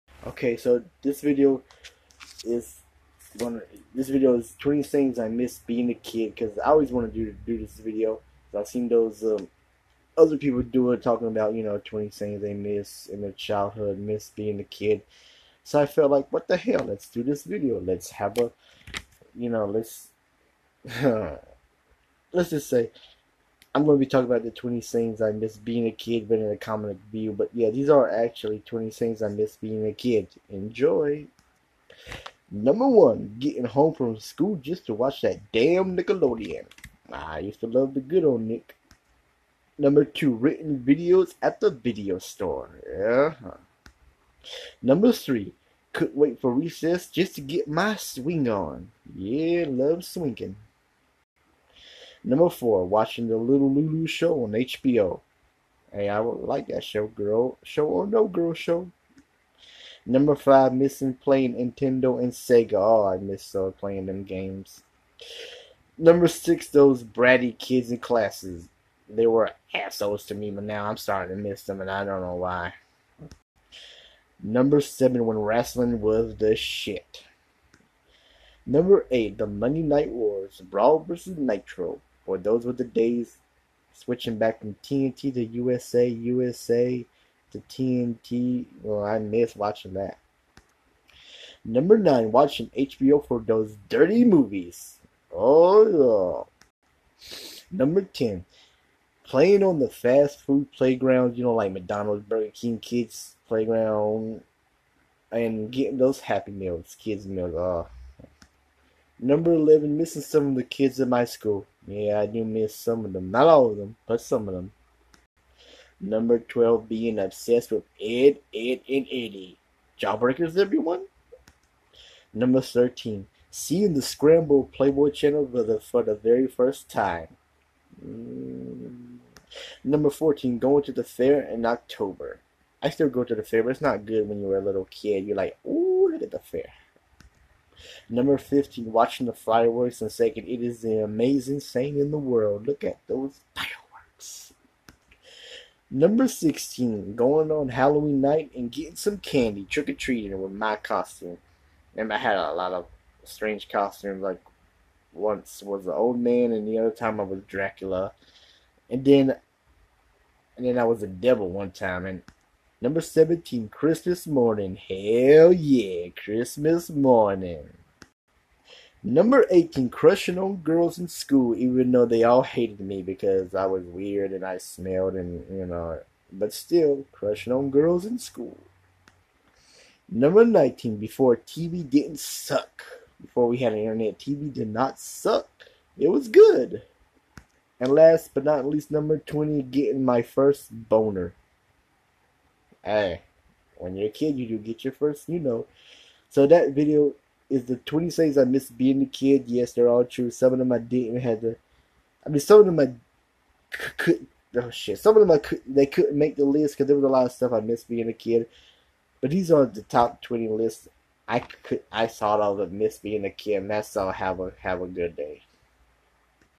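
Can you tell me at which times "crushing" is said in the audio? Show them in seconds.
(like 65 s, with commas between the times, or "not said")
169 s, 177 s.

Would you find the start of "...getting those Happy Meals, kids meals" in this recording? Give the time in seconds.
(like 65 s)
105 s.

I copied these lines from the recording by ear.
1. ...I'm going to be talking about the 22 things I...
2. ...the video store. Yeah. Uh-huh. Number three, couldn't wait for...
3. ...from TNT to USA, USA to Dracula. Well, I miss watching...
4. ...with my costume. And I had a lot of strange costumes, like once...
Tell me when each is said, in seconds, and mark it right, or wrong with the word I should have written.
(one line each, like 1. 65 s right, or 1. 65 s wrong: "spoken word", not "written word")
1. 23 s wrong: "20", not "22"
2. 41 s right
3. 84 s wrong: "TNT", not "Dracula"
4. 150 s right.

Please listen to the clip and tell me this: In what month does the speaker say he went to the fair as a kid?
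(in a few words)
October.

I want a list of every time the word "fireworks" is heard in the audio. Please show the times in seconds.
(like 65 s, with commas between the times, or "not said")
139 s, 143 s.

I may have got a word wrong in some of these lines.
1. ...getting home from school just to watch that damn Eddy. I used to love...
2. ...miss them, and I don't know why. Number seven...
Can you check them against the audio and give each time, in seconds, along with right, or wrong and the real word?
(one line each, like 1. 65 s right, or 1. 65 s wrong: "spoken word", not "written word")
1. 33 s wrong: "Nickelodeon", not "Eddy"
2. 71 s right.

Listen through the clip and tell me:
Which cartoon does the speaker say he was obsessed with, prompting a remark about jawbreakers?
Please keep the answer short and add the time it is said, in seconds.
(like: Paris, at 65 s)
Ed, Edd and Eddy, at 117 s.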